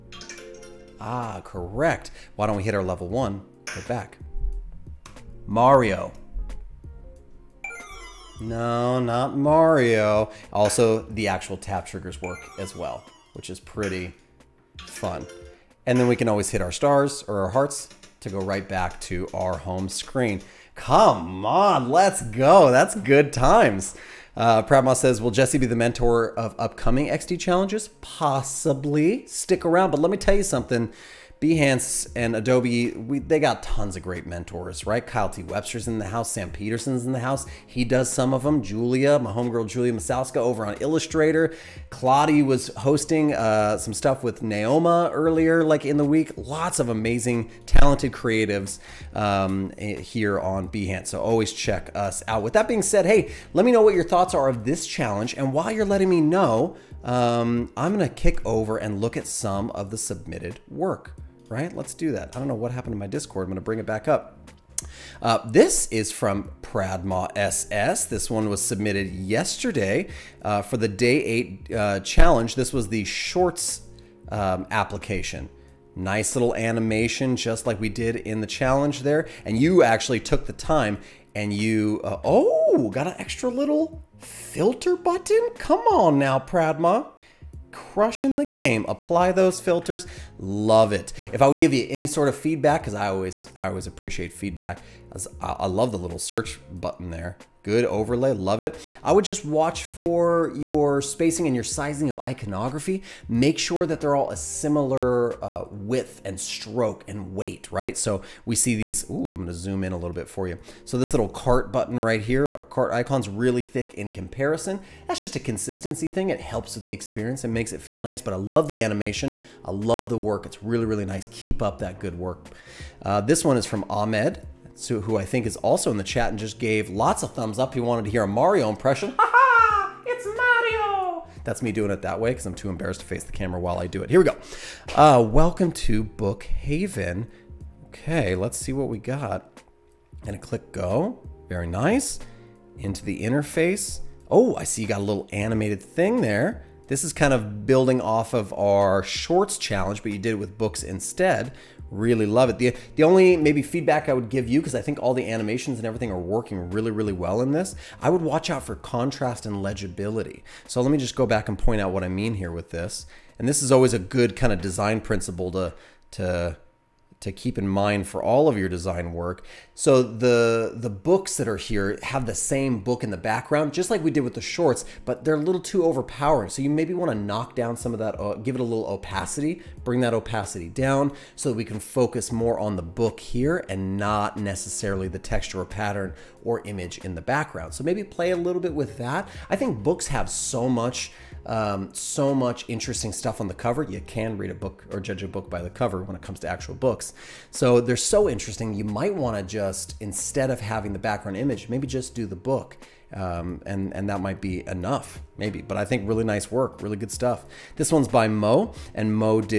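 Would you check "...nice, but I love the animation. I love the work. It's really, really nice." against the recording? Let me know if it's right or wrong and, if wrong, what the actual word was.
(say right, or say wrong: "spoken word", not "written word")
right.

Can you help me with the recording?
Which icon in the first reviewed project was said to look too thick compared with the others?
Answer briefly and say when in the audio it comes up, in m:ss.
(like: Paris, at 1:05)
cart icon, at 1:52.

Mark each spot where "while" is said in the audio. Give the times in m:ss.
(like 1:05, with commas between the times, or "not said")
0:55, 2:13.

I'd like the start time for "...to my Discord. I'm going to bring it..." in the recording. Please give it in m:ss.
1:02.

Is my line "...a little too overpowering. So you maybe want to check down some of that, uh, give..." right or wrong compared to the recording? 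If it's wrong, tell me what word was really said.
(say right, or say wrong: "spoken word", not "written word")
wrong: "knock", not "check".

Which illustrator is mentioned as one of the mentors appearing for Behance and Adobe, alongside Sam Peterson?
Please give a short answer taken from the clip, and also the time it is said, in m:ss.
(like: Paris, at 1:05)
Kyle T. Webster, at 0:35.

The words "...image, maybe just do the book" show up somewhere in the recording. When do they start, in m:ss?
3:21.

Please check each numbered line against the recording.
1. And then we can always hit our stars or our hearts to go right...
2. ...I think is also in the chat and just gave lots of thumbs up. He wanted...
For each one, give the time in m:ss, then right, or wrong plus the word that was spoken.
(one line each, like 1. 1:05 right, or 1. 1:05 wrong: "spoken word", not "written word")
1. 0:15 right
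2. 2:05 right.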